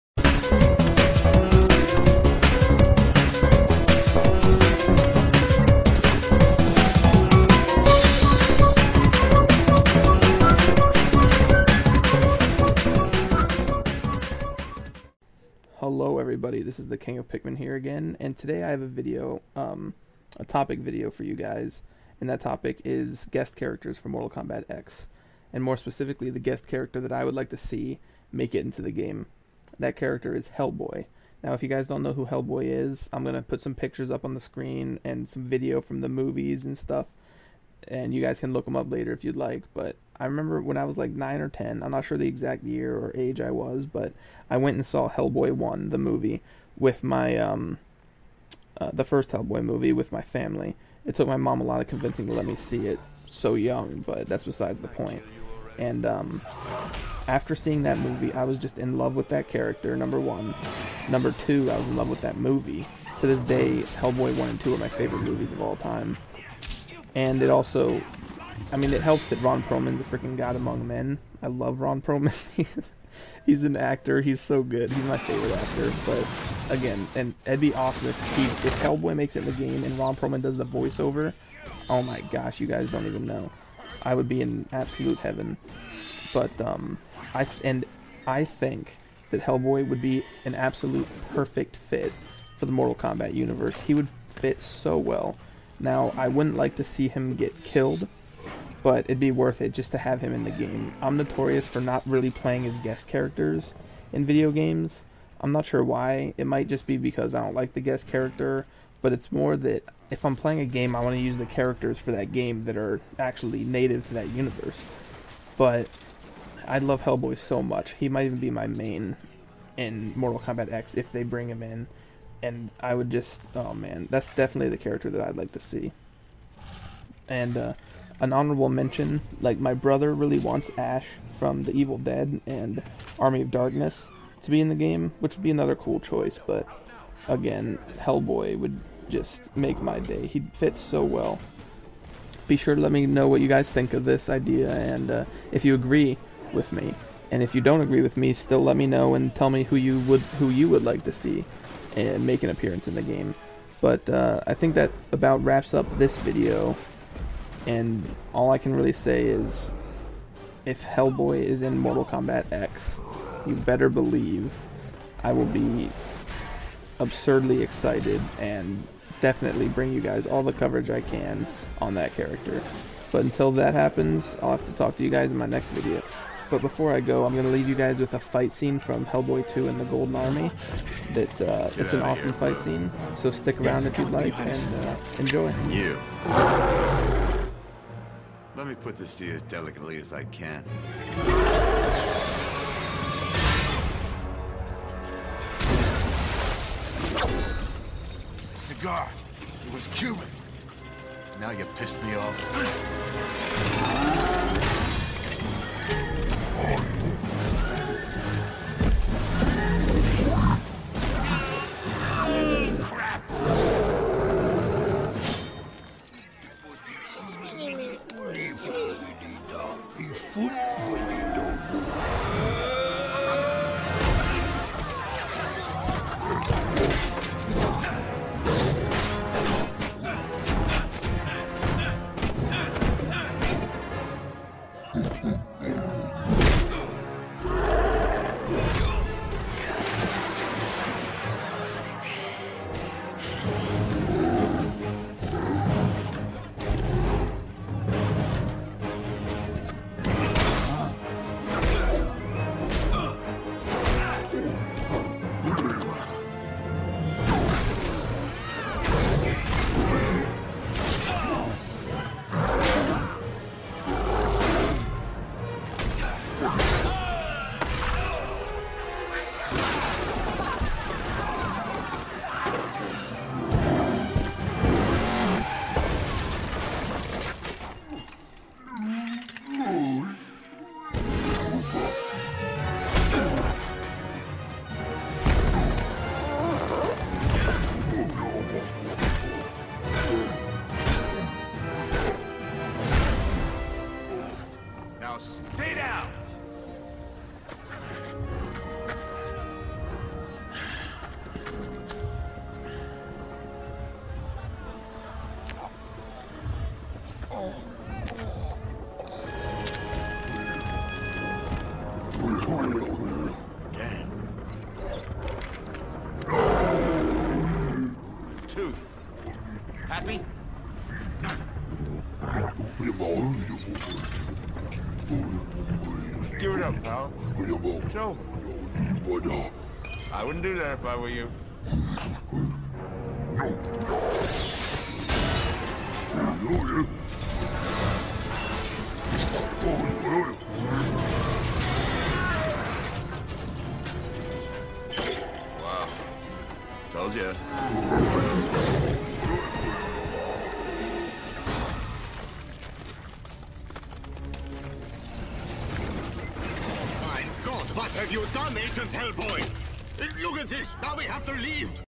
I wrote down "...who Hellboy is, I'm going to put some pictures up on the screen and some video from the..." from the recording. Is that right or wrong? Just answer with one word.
right.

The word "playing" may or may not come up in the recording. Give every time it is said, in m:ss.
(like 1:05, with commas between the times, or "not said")
1:42, 1:50.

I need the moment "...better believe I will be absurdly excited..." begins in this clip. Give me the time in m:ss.
2:43.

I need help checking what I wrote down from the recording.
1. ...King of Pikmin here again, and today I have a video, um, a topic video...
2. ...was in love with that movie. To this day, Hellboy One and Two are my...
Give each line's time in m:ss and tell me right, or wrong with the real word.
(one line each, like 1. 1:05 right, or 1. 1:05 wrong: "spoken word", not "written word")
1. 0:16 right
2. 1:01 right.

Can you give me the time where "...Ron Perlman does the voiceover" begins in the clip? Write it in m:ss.
1:19.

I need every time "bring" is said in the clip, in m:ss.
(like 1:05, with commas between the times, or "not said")
2:01, 2:49.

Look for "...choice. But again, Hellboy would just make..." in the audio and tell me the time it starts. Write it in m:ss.
2:15.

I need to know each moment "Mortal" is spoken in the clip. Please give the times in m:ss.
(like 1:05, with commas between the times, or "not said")
0:24, 1:32, 2:00, 2:41.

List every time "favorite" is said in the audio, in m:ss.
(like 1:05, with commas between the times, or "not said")
1:04, 1:15.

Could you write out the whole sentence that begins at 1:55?
But I love Hellboy so much.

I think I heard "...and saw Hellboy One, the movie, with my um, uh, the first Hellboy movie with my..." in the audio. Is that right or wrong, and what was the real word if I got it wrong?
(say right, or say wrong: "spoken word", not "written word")
right.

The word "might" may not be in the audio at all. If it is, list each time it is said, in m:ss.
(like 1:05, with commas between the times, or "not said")
1:46, 1:58.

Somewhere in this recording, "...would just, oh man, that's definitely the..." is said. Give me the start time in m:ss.
2:02.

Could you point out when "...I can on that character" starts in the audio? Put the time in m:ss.
2:50.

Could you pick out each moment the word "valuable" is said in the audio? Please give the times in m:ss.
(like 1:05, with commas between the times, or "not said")
5:27.